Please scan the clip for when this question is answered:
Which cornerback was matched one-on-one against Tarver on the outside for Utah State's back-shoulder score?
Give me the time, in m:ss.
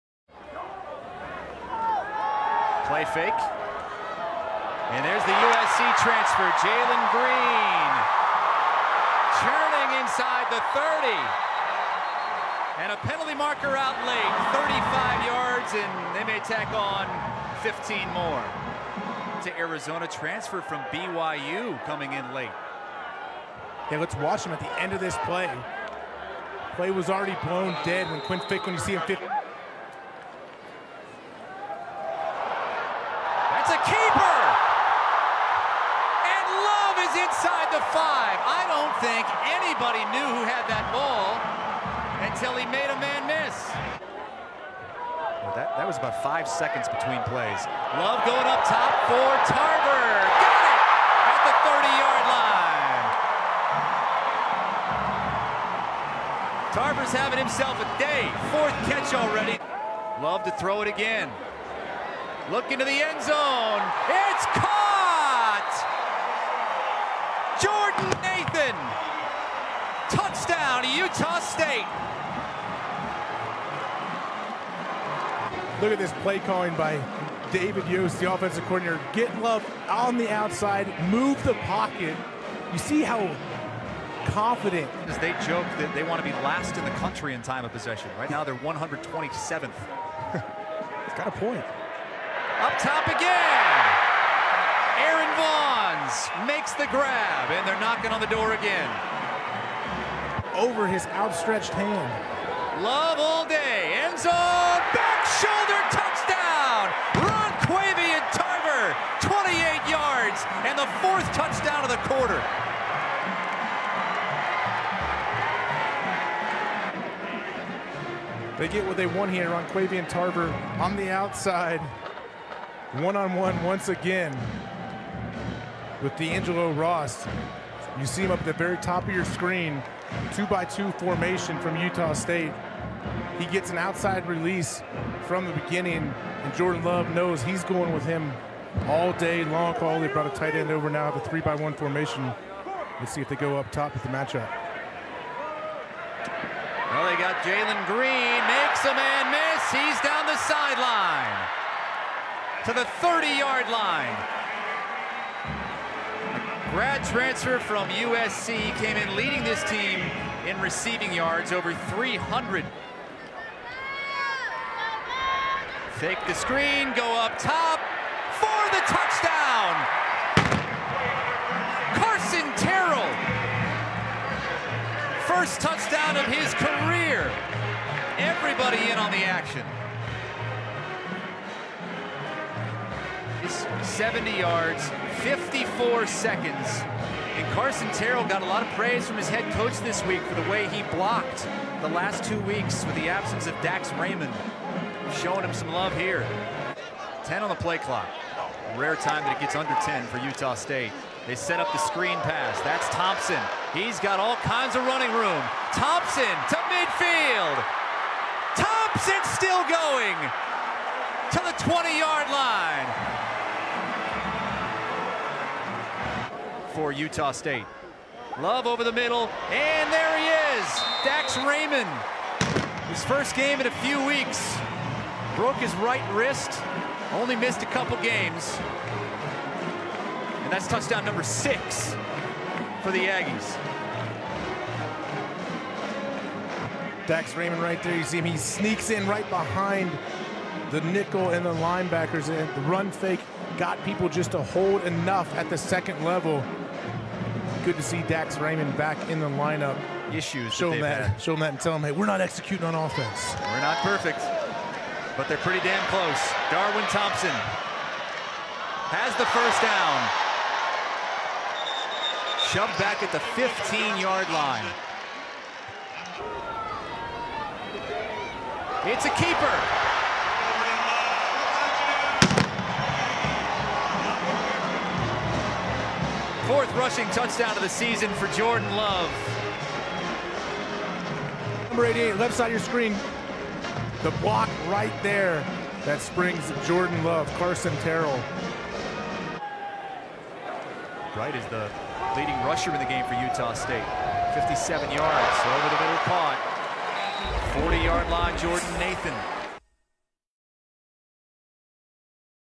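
2:06.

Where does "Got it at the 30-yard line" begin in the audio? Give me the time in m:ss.
0:50.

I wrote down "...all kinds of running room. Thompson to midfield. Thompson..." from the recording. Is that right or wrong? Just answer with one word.
right.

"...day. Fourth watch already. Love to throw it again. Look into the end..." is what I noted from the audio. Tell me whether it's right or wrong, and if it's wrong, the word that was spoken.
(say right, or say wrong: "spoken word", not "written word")
wrong: "catch", not "watch".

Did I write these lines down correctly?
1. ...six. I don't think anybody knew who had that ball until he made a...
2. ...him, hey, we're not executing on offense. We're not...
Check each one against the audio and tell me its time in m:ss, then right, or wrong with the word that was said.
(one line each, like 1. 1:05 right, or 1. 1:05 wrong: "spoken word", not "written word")
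1. 0:37 wrong: "five", not "six"
2. 4:11 right.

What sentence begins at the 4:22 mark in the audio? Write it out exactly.
Shoved back at the 15-yard line.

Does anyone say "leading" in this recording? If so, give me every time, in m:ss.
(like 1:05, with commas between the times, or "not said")
2:39, 4:52.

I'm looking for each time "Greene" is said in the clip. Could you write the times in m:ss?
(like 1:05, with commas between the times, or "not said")
0:07, 2:27.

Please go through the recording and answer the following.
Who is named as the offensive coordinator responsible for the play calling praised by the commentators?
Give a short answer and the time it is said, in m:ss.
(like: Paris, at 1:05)
David Yost, at 1:17.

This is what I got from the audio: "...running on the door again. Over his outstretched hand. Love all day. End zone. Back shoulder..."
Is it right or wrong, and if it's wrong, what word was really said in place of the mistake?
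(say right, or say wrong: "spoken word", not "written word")
wrong: "knocking", not "running".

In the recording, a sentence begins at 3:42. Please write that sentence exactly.
His first game in a few weeks.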